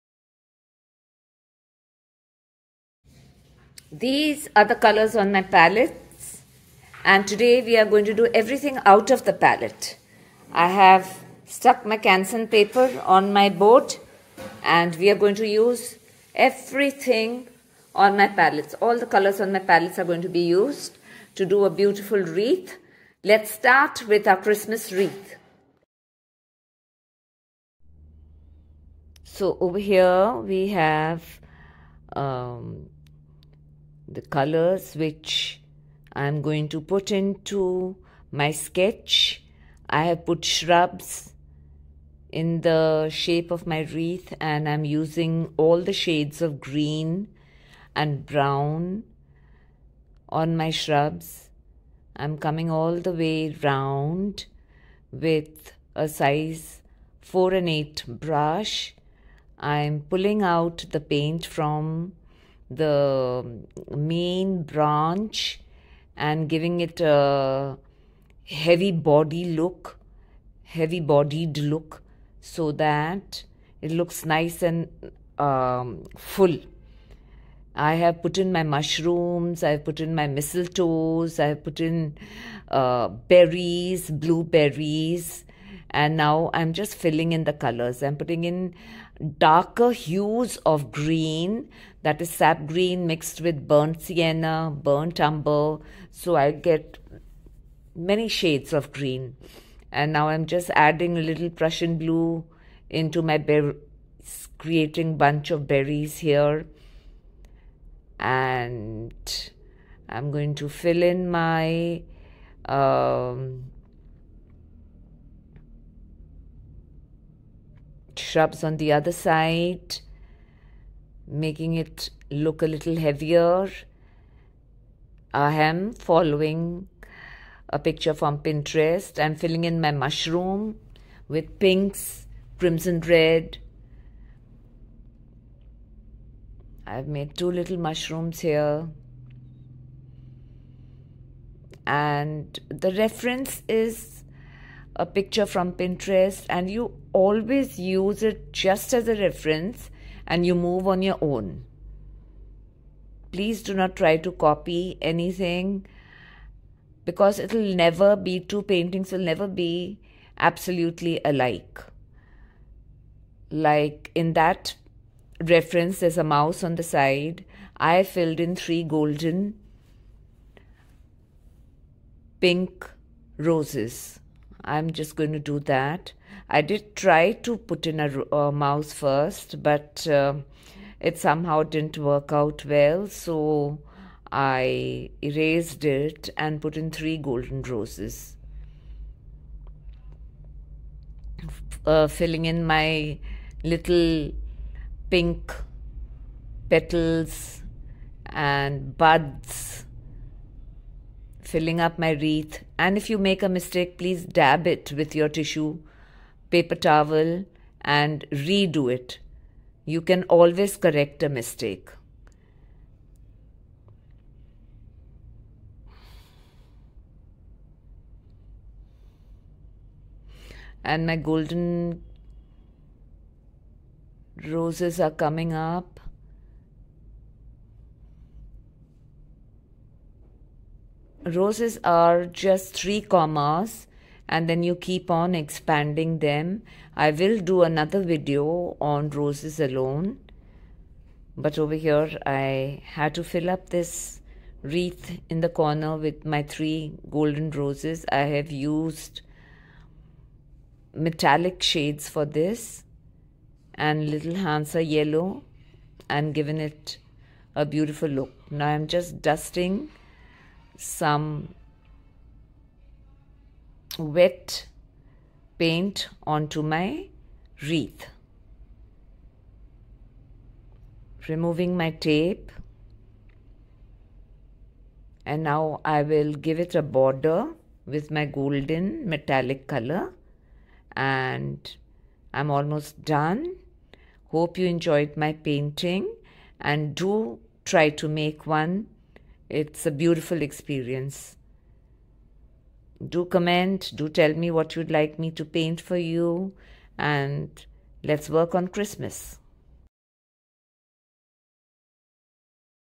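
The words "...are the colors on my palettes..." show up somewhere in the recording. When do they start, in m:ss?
0:04.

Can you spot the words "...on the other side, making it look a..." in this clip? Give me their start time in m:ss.
1:58.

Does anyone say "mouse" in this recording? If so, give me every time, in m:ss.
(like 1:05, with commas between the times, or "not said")
2:46, 2:58.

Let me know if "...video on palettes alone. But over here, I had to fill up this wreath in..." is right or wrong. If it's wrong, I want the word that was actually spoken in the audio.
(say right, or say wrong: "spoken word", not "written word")
wrong: "roses", not "palettes".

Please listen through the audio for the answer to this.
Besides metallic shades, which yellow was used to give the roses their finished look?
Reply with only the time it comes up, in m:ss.
4:14.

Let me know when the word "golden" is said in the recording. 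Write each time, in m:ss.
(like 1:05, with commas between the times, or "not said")
2:48, 3:07, 3:41, 4:07, 4:38.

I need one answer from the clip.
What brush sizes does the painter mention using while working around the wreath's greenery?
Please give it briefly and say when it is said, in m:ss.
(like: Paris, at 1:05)
4 and 8, at 0:56.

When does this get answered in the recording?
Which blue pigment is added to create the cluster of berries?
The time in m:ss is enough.
1:41.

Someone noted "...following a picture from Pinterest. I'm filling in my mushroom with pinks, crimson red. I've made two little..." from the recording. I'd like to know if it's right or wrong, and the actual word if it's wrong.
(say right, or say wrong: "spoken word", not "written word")
right.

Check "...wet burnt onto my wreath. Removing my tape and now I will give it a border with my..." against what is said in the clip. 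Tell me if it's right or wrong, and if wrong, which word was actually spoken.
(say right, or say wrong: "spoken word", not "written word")
wrong: "paint", not "burnt".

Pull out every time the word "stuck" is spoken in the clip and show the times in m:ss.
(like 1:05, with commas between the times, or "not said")
0:11.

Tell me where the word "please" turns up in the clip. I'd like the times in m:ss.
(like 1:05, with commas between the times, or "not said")
2:33, 3:23.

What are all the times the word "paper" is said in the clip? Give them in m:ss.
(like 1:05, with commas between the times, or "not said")
0:12, 3:26.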